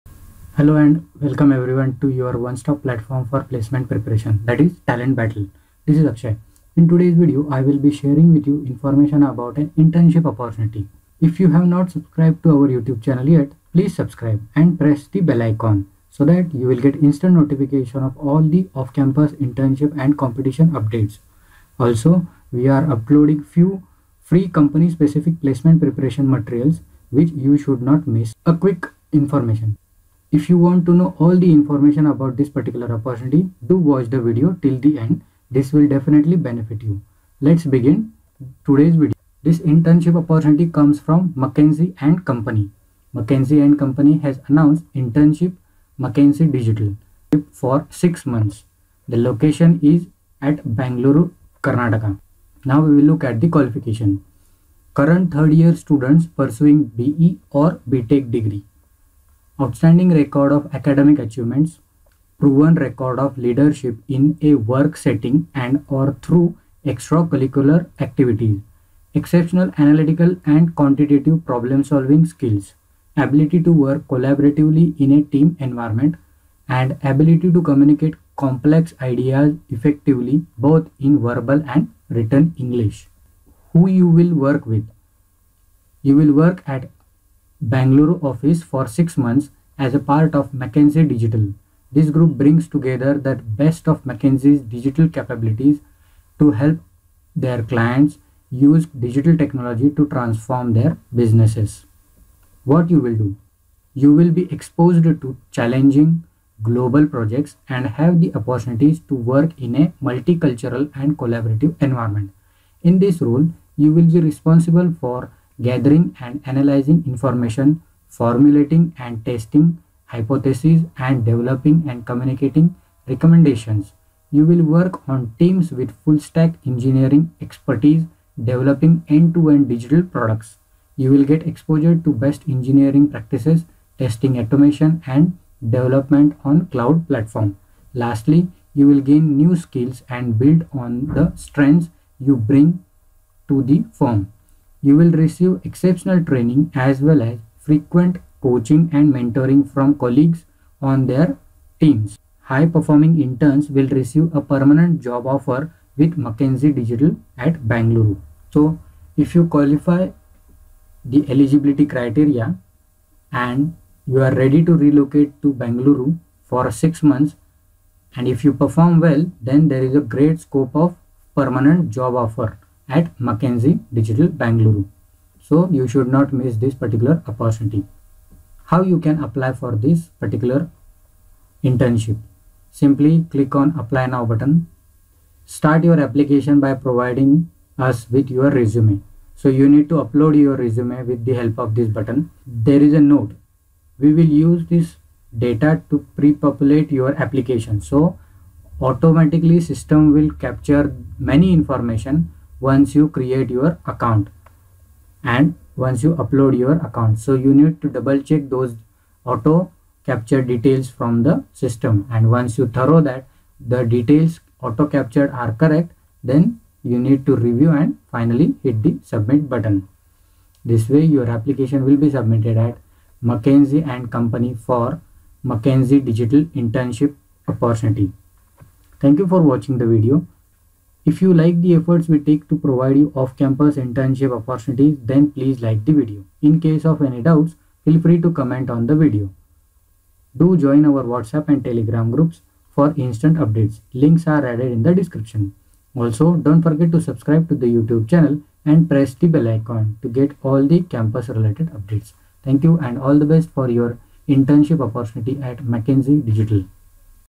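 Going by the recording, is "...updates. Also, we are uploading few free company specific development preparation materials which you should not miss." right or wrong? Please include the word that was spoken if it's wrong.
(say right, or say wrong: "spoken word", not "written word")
wrong: "placement", not "development".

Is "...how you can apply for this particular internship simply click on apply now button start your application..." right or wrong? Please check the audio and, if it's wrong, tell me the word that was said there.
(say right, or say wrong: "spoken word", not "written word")
right.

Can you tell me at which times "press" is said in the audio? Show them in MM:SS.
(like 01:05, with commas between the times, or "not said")
00:14, 04:08.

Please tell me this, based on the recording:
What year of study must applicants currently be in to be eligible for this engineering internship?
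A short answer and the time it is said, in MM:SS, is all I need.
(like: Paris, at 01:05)
Third year, at 00:55.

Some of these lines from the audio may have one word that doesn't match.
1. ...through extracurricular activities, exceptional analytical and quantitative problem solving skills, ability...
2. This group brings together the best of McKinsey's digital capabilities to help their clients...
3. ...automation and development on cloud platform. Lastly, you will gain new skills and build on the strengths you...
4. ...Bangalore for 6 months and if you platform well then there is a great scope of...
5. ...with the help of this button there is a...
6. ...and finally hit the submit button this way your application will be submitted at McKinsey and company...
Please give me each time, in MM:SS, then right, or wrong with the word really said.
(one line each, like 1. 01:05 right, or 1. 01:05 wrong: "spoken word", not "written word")
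1. 01:06 right
2. 01:31 right
3. 02:14 right
4. 02:45 wrong: "perform", not "platform"
5. 03:11 right
6. 03:37 right.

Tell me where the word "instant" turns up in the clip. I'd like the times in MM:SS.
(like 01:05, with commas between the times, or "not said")
00:17, 04:02.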